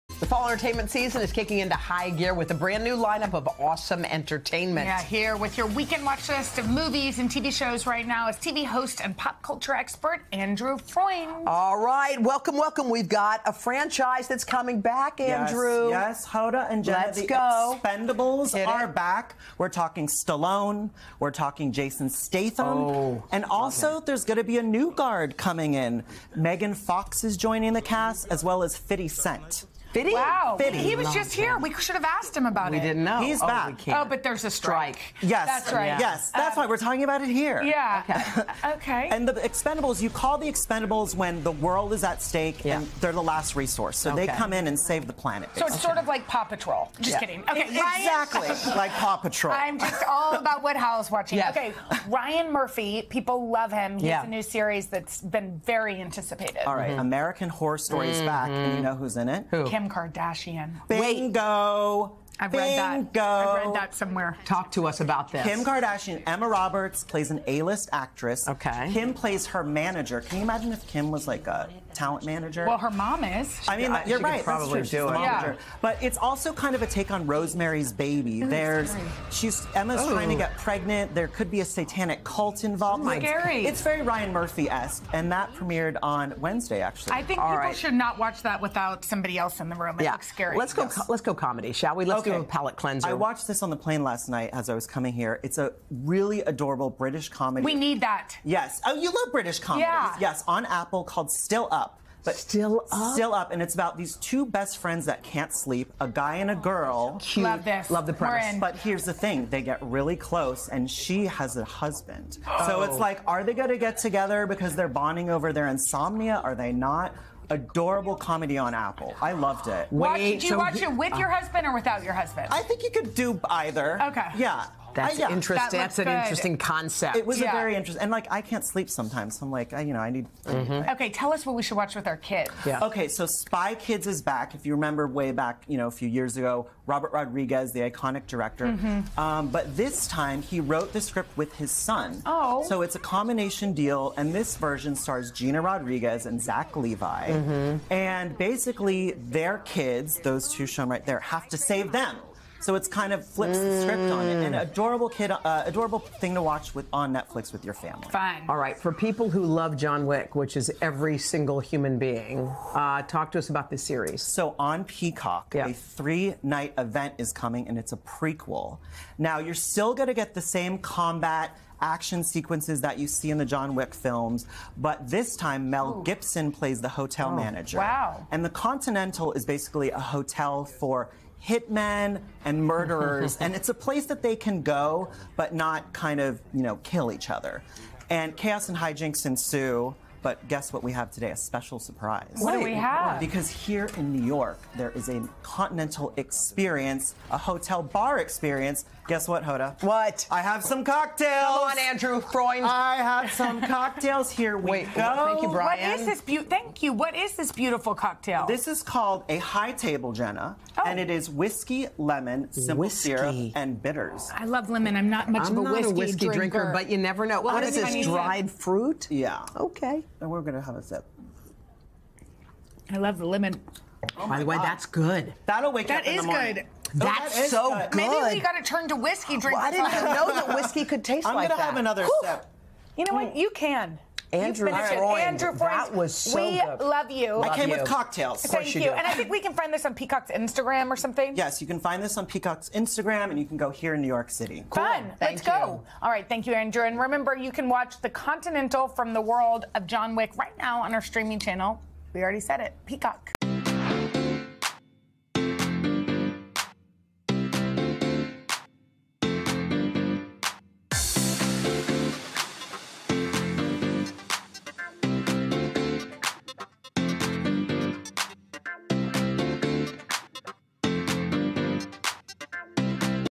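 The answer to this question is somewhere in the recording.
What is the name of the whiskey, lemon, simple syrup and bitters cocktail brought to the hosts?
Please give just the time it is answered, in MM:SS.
03:29.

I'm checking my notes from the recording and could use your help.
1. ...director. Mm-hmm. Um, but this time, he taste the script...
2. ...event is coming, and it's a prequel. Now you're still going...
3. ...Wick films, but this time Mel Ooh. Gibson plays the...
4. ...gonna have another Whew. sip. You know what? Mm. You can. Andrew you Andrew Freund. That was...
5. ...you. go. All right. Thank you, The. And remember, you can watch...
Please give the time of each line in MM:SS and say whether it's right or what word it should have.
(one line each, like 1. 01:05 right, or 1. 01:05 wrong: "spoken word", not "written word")
1. 02:18 wrong: "wrote", not "taste"
2. 02:46 right
3. 02:53 right
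4. 03:51 right
5. 04:05 wrong: "Andrew", not "The".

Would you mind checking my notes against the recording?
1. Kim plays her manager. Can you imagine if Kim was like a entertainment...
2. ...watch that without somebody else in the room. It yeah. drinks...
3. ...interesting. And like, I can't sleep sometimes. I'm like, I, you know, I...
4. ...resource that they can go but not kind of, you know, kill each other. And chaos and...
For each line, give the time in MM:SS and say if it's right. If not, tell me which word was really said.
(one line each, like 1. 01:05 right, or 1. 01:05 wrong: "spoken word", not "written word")
1. 01:08 wrong: "talent", not "entertainment"
2. 01:28 wrong: "looks", not "drinks"
3. 02:07 right
4. 03:03 wrong: "place", not "resource".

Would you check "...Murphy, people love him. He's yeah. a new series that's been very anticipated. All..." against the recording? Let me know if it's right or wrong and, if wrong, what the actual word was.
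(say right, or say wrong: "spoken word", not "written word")
right.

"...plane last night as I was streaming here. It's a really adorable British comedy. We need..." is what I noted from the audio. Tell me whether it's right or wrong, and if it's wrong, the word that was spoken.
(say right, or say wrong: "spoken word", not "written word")
wrong: "coming", not "streaming".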